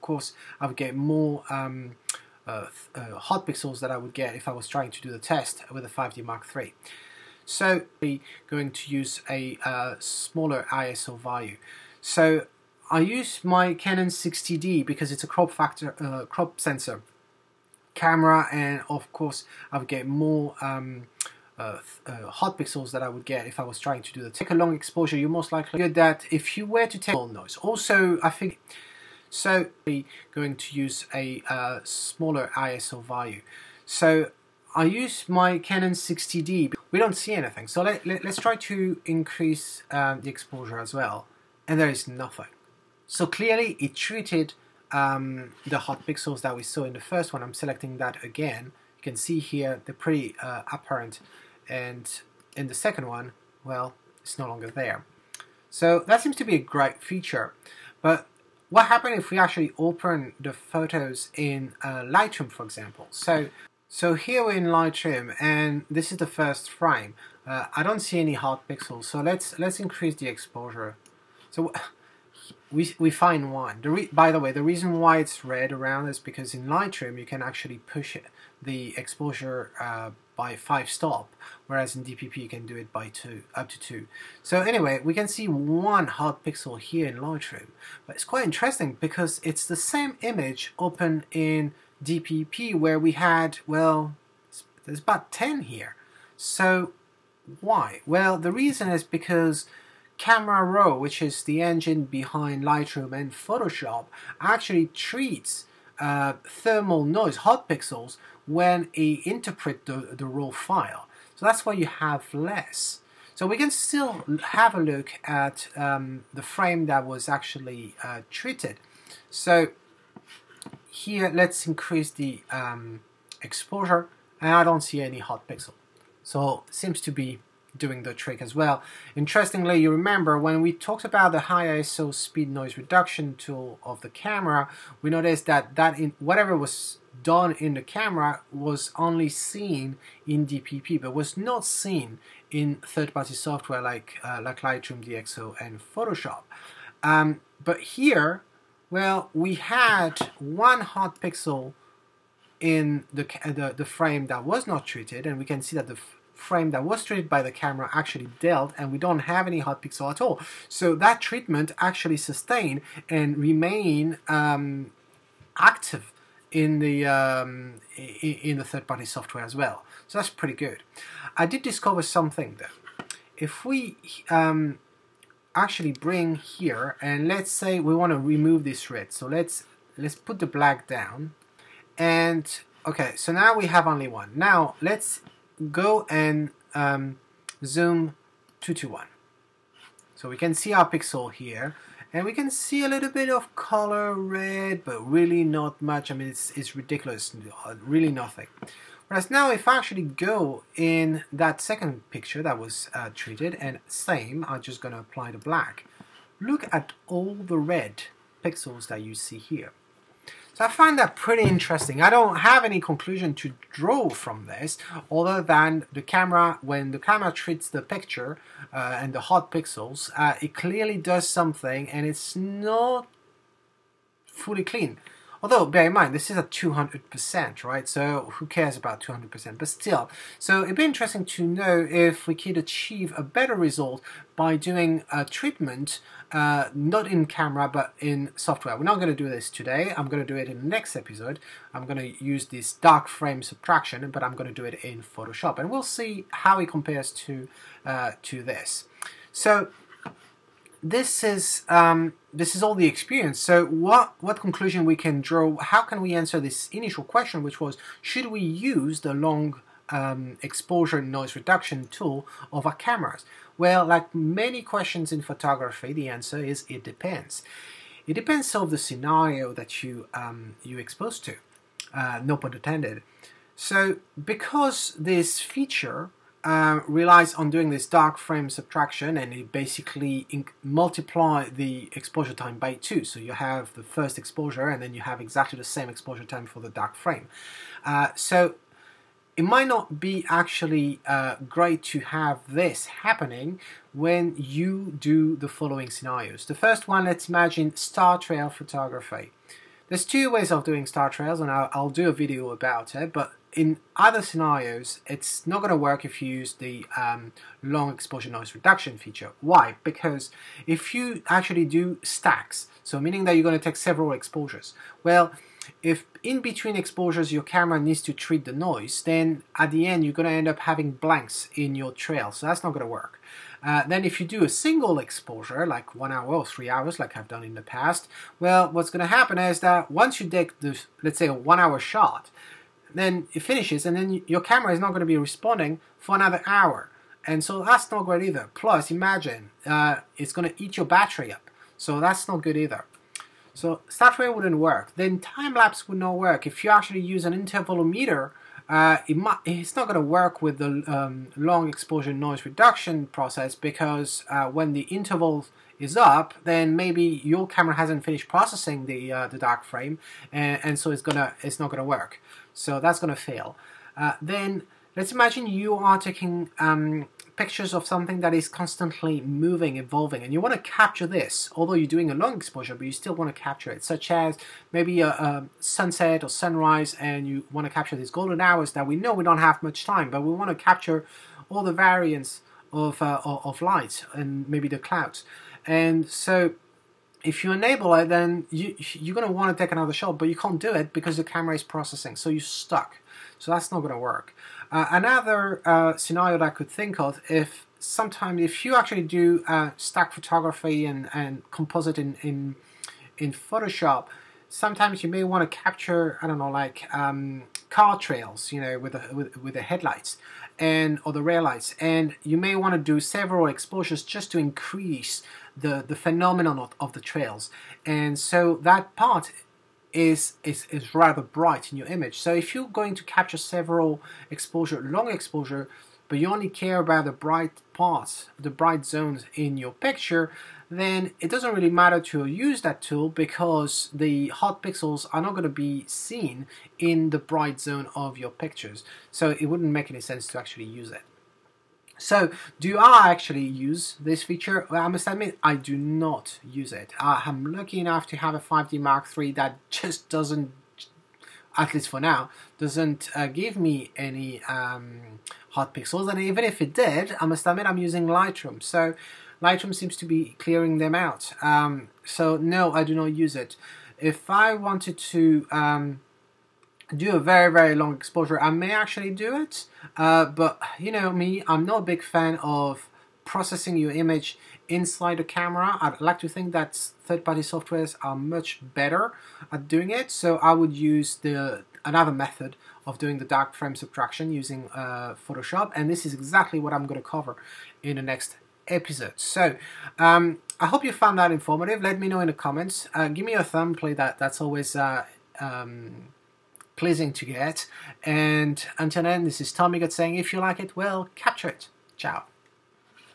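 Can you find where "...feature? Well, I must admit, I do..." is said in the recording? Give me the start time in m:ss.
7:24.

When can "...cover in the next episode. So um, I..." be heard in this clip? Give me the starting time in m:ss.
8:07.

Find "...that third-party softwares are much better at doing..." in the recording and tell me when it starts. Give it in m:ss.
7:56.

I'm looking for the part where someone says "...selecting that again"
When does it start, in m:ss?
0:47.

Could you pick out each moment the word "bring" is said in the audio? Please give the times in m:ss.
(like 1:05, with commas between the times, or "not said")
2:55.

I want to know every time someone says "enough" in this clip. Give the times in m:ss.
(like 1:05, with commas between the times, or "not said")
7:27.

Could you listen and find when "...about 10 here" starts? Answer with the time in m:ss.
1:34.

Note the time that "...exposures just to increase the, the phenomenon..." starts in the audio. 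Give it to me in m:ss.
6:53.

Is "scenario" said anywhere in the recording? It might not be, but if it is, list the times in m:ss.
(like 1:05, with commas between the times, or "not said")
4:28, 4:55, 5:04, 6:35.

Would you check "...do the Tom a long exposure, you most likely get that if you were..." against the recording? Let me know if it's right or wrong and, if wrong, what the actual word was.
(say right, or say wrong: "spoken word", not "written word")
wrong: "Take", not "Tom".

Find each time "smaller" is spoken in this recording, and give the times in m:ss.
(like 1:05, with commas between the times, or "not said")
0:09, 0:31.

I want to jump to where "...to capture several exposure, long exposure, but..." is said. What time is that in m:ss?
7:02.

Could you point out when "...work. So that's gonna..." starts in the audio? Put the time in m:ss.
6:01.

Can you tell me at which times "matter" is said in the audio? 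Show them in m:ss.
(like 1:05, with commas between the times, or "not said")
7:11.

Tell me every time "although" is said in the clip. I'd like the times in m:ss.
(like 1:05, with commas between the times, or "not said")
3:45, 6:11.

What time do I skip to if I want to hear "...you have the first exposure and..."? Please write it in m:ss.
4:43.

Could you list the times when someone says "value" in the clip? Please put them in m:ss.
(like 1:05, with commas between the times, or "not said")
0:11, 0:33.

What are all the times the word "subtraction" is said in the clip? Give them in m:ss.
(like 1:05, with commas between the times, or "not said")
4:03, 4:38, 8:03.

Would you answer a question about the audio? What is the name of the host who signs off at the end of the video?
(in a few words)
Tom Migot.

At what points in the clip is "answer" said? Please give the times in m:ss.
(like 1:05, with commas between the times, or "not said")
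4:16, 4:26.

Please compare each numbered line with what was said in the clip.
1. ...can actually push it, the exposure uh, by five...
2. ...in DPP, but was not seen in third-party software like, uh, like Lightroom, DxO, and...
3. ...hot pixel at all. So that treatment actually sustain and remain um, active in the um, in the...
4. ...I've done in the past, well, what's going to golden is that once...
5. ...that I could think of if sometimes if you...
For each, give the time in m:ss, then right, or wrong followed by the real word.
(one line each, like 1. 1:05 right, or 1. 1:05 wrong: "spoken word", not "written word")
1. 1:17 right
2. 2:20 right
3. 2:39 right
4. 5:27 wrong: "happen", not "golden"
5. 6:36 right.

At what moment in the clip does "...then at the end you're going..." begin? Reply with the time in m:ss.
5:19.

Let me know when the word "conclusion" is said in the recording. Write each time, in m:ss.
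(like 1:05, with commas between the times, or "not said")
3:32, 4:14.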